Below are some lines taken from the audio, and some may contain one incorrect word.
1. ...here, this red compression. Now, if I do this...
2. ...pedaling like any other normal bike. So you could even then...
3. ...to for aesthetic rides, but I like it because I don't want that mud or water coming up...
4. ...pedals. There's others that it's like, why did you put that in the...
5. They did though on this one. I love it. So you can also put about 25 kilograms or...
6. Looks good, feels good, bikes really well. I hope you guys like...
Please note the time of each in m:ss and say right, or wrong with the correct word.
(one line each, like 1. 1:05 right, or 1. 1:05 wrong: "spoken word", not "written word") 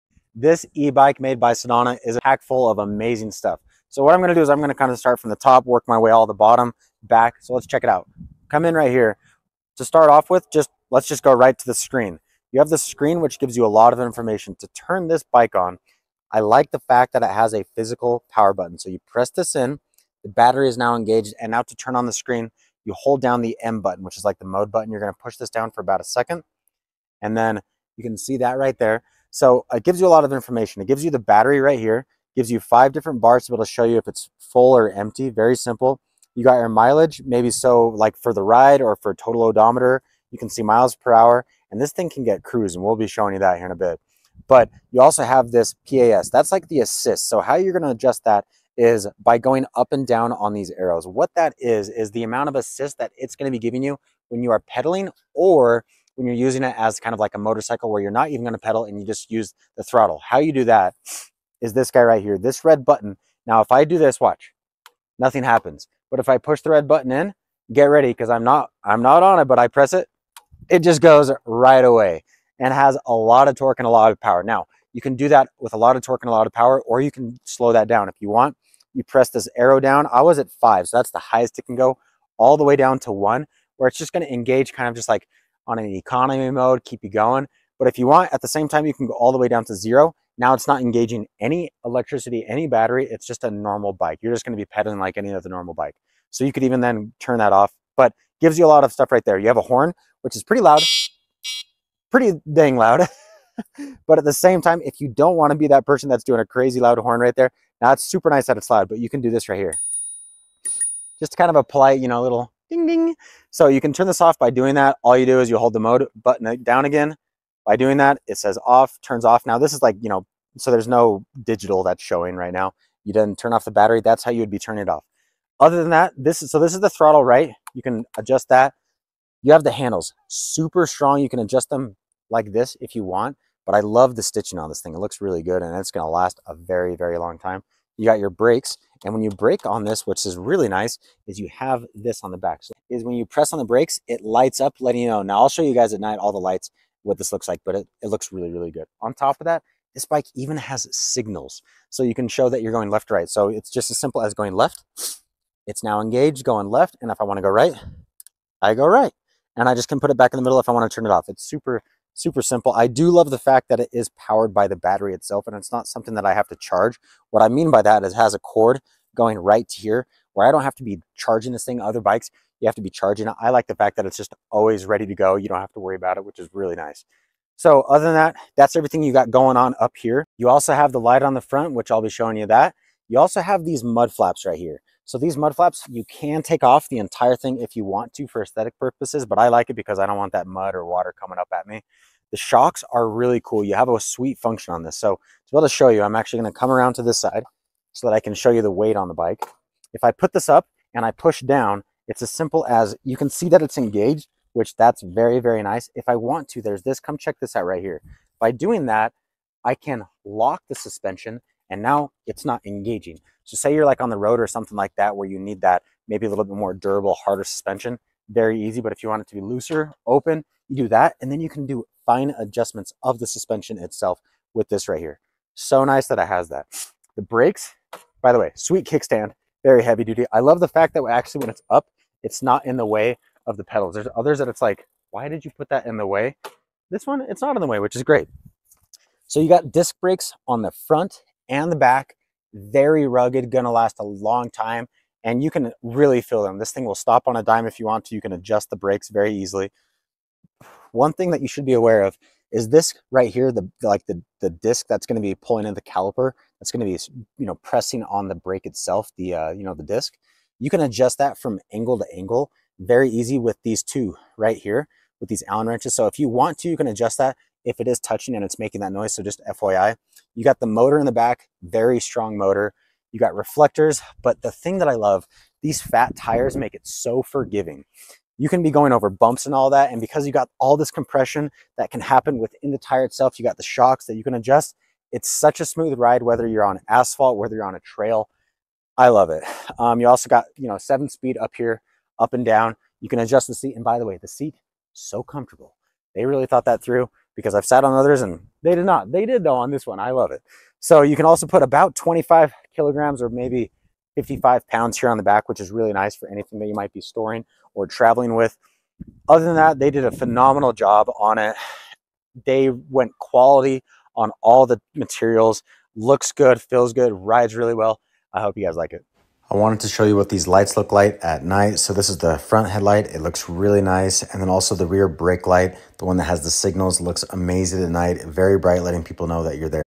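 1. 1:02 wrong: "button", not "compression"
2. 1:34 right
3. 3:08 wrong: "purposes", not "rides"
4. 3:53 right
5. 4:59 right
6. 5:15 wrong: "rides", not "bikes".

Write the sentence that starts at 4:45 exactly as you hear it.
It's such a smooth ride, whether you're on asphalt, whether you're on a trail.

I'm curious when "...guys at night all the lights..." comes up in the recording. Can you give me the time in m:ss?
2:25.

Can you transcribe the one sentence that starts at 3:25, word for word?
If I want to, there's this, come check this out right here.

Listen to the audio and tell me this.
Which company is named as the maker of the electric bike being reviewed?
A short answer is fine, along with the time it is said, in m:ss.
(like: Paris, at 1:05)
Senada, at 0:01.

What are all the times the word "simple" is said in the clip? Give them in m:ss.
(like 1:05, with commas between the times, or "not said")
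0:35, 2:33, 2:42, 3:22.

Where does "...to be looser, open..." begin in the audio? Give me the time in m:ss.
3:39.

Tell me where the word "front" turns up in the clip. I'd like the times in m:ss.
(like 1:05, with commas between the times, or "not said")
3:01, 4:00, 5:22.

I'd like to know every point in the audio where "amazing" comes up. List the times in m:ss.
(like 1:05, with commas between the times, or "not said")
0:02, 5:27.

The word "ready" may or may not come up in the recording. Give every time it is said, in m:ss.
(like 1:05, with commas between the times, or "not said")
1:07, 2:54.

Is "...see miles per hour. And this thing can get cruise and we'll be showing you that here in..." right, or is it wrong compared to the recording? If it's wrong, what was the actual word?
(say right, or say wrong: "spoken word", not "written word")
right.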